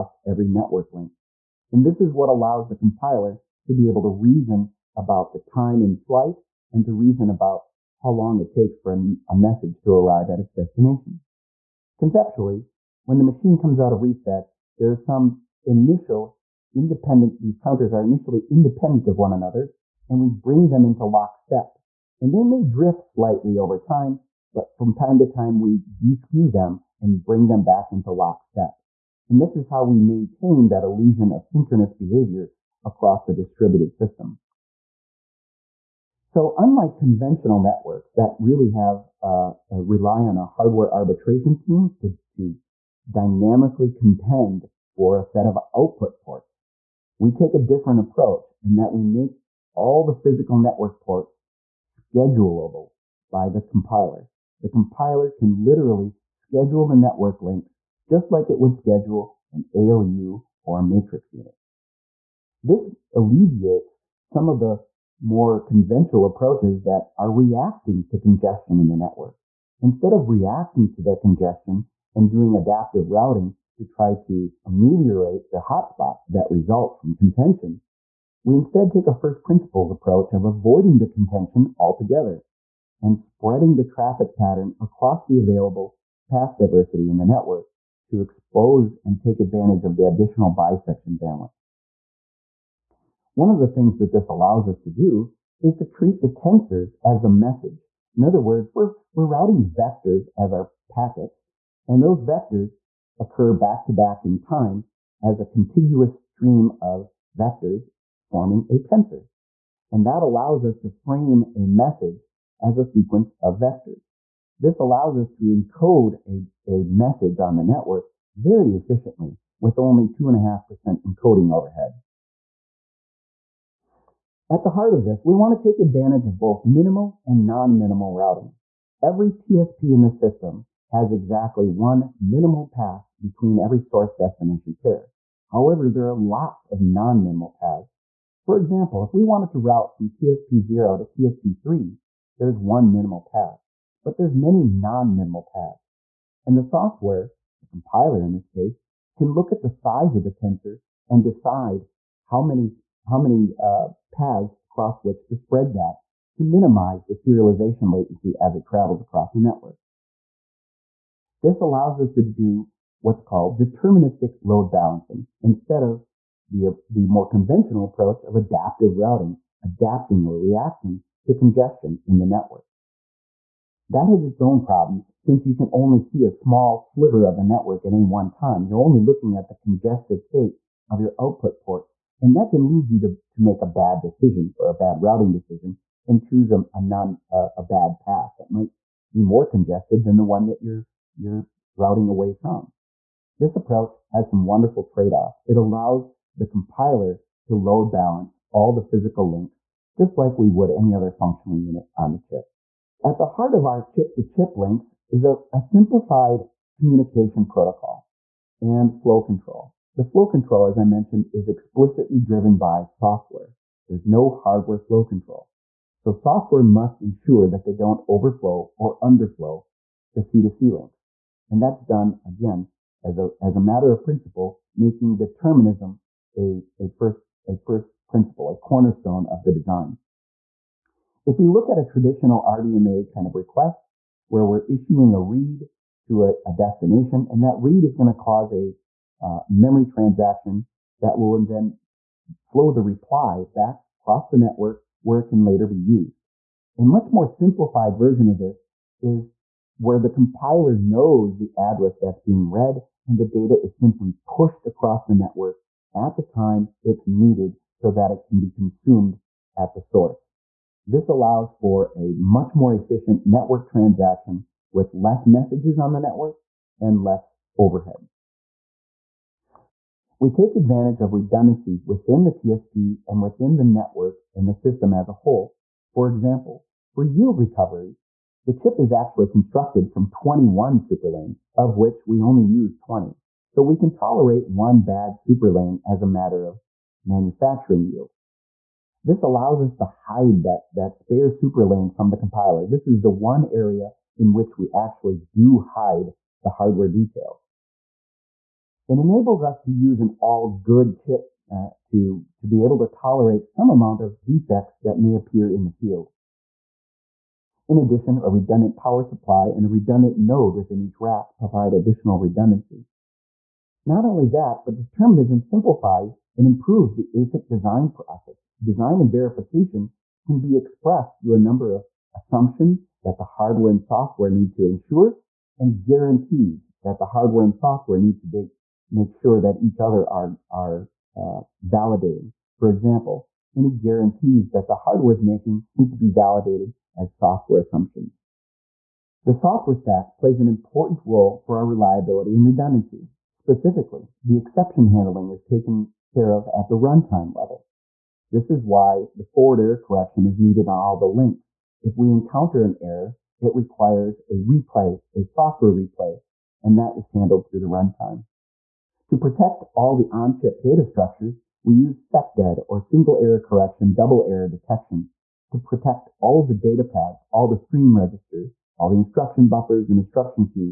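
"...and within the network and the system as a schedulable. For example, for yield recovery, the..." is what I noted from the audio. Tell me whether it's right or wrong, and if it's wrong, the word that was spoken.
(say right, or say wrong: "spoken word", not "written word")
wrong: "whole", not "schedulable".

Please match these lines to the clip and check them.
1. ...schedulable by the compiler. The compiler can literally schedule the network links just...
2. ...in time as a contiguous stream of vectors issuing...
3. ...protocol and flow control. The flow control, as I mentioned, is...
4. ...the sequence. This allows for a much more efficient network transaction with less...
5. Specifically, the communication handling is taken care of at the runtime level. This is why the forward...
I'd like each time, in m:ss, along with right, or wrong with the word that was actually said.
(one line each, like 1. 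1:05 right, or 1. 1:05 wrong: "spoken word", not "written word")
1. 0:51 right
2. 1:44 wrong: "forming", not "issuing"
3. 3:27 right
4. 4:19 wrong: "source", not "sequence"
5. 5:43 wrong: "exception", not "communication".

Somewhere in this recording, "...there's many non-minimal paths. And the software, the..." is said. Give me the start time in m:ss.
2:24.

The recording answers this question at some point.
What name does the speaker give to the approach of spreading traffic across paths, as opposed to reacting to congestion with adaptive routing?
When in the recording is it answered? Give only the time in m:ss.
2:43.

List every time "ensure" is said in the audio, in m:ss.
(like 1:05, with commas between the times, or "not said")
3:37, 5:24.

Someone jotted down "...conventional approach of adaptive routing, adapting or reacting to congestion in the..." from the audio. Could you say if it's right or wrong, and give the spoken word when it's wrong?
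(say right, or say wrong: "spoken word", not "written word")
right.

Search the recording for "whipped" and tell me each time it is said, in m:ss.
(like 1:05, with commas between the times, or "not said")
not said.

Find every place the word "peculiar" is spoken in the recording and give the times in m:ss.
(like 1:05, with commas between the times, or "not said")
not said.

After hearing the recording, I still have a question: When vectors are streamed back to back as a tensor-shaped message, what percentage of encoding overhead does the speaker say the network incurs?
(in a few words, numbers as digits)
2.5%.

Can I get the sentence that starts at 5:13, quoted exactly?
Not only that, but determinism simplifies and improves the ASIC design process.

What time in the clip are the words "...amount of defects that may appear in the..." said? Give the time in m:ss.
5:03.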